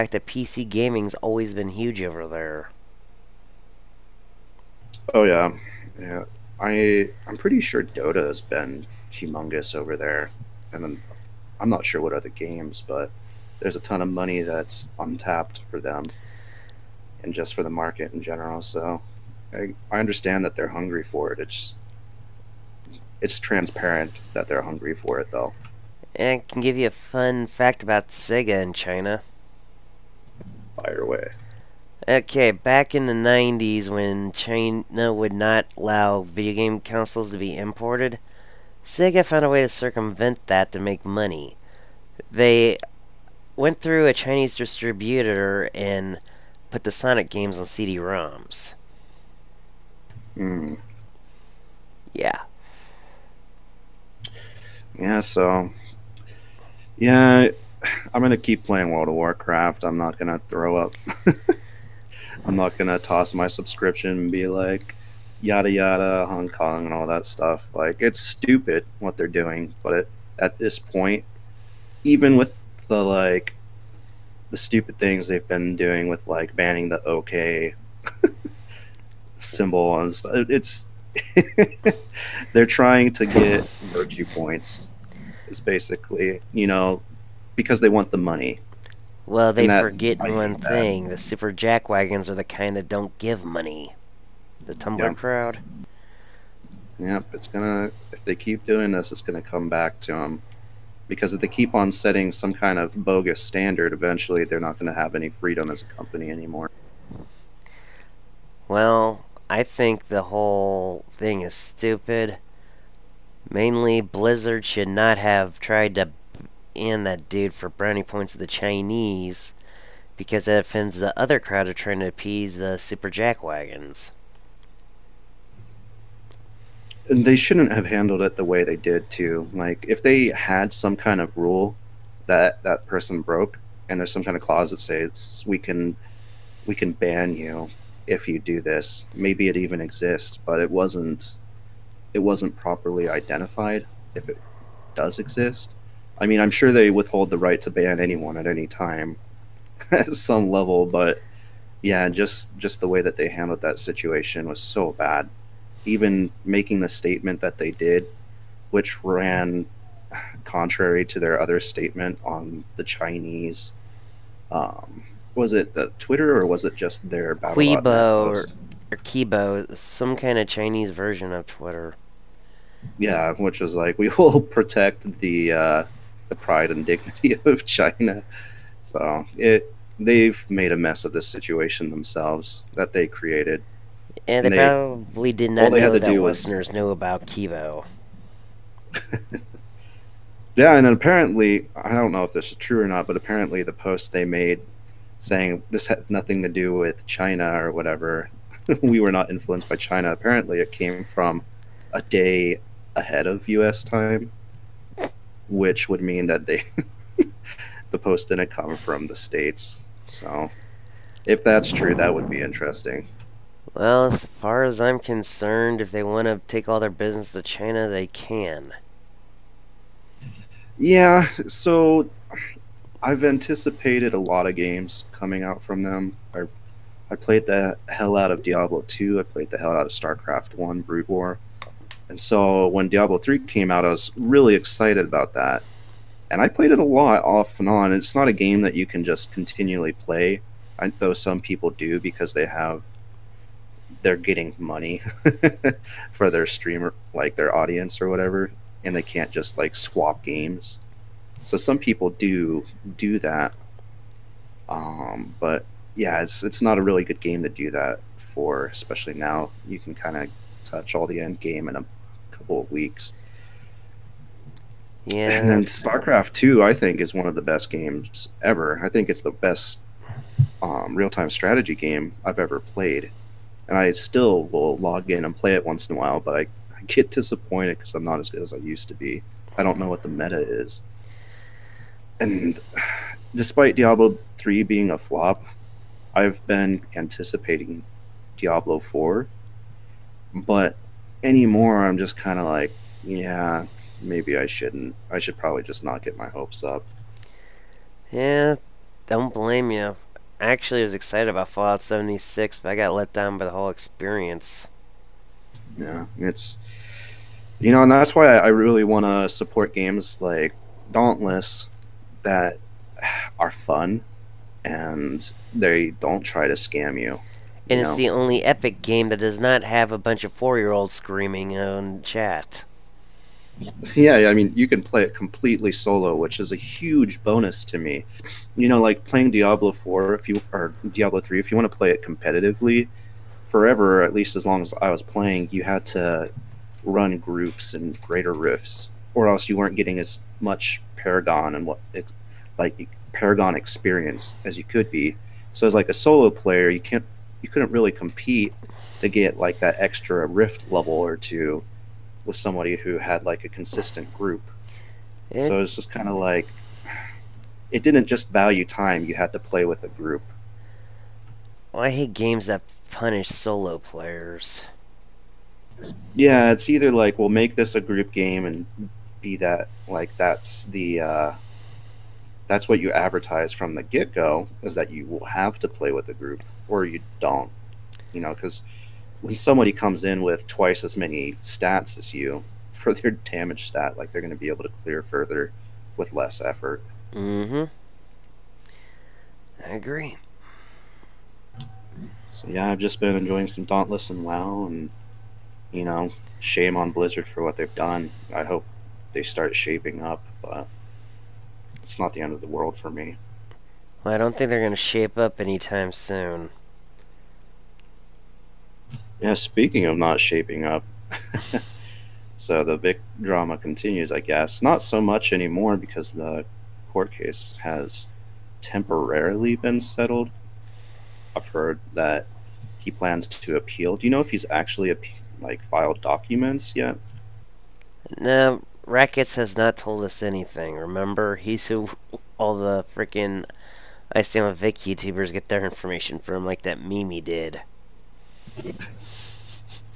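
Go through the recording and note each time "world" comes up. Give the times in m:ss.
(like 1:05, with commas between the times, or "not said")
0:58, 6:42.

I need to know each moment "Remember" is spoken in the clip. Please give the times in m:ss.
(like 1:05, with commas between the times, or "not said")
7:10.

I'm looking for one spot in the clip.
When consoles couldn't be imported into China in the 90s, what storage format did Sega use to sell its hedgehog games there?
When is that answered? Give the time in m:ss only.
0:47.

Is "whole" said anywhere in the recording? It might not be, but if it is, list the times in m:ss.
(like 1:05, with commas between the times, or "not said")
1:50, 5:03.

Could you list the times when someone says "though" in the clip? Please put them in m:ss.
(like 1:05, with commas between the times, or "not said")
0:25, 4:00.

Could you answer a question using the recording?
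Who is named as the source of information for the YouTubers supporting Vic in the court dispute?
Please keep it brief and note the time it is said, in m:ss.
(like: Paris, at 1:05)
Rackets, at 7:08.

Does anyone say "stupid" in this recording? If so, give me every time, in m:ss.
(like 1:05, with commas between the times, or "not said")
1:08, 1:14, 1:51.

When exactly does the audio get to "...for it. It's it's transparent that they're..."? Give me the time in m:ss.
0:21.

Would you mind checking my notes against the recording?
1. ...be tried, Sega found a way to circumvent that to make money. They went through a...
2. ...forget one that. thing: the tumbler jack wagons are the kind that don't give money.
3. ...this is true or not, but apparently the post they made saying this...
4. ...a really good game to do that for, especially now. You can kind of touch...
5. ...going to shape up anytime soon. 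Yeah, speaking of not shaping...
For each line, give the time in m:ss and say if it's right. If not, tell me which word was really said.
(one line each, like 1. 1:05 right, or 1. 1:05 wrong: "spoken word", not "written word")
1. 0:37 wrong: "imported", not "tried"
2. 1:29 wrong: "super", not "tumbler"
3. 3:12 right
4. 4:16 right
5. 6:44 right.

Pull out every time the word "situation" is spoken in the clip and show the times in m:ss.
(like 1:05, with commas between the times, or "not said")
2:33, 3:01.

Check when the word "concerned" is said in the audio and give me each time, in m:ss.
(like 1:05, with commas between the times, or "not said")
3:34.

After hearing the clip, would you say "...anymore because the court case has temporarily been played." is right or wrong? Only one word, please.
wrong.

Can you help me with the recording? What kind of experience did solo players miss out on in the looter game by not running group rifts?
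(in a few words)
Paragon experience.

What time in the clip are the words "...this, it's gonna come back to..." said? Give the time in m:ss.
1:38.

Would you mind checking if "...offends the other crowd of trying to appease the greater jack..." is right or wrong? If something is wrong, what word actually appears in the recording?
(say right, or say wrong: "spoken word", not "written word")
wrong: "super", not "greater".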